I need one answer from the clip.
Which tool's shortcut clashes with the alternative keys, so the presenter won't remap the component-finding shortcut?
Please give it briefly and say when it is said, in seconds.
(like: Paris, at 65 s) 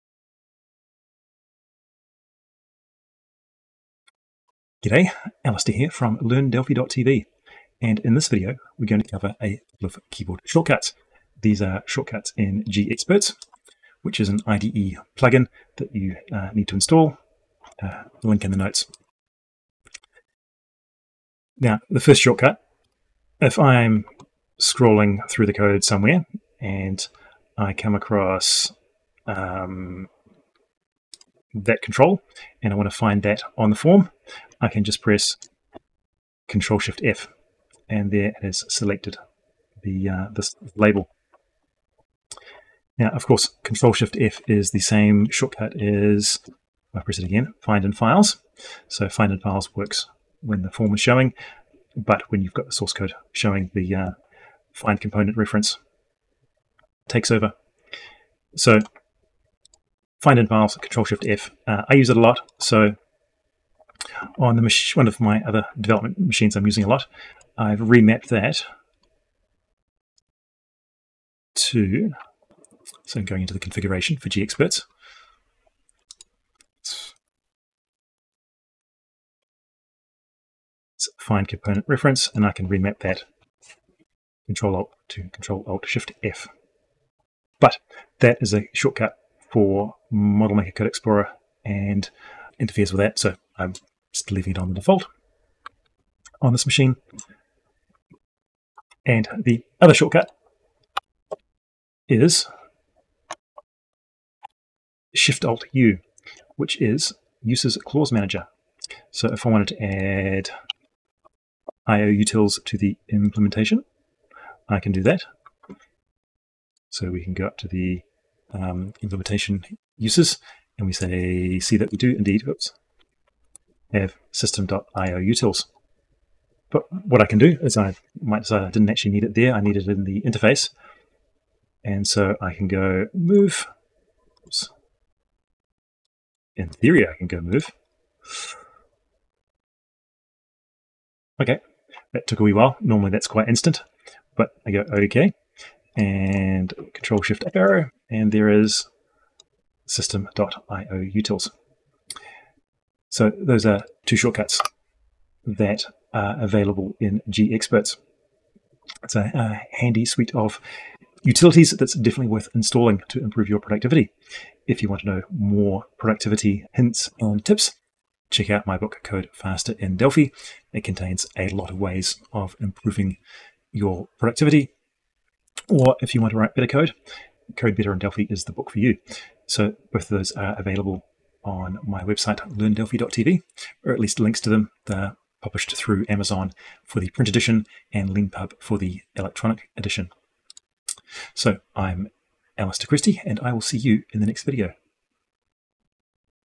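Model Maker Code Explorer, at 90 s.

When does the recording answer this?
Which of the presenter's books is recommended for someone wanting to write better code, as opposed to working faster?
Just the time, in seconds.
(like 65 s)
177 s.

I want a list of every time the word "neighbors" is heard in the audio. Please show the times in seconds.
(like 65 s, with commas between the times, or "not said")
not said.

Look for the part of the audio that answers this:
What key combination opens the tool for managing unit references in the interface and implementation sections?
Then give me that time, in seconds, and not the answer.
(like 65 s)
105 s.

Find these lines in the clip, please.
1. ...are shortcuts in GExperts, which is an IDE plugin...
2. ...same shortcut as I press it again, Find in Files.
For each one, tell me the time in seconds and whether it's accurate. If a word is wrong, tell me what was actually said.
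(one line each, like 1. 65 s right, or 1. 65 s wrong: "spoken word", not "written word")
1. 11 s right
2. 44 s right.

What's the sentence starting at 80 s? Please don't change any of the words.
It's find component reference, and I can remap that Control Alt to Control Alt Shift F.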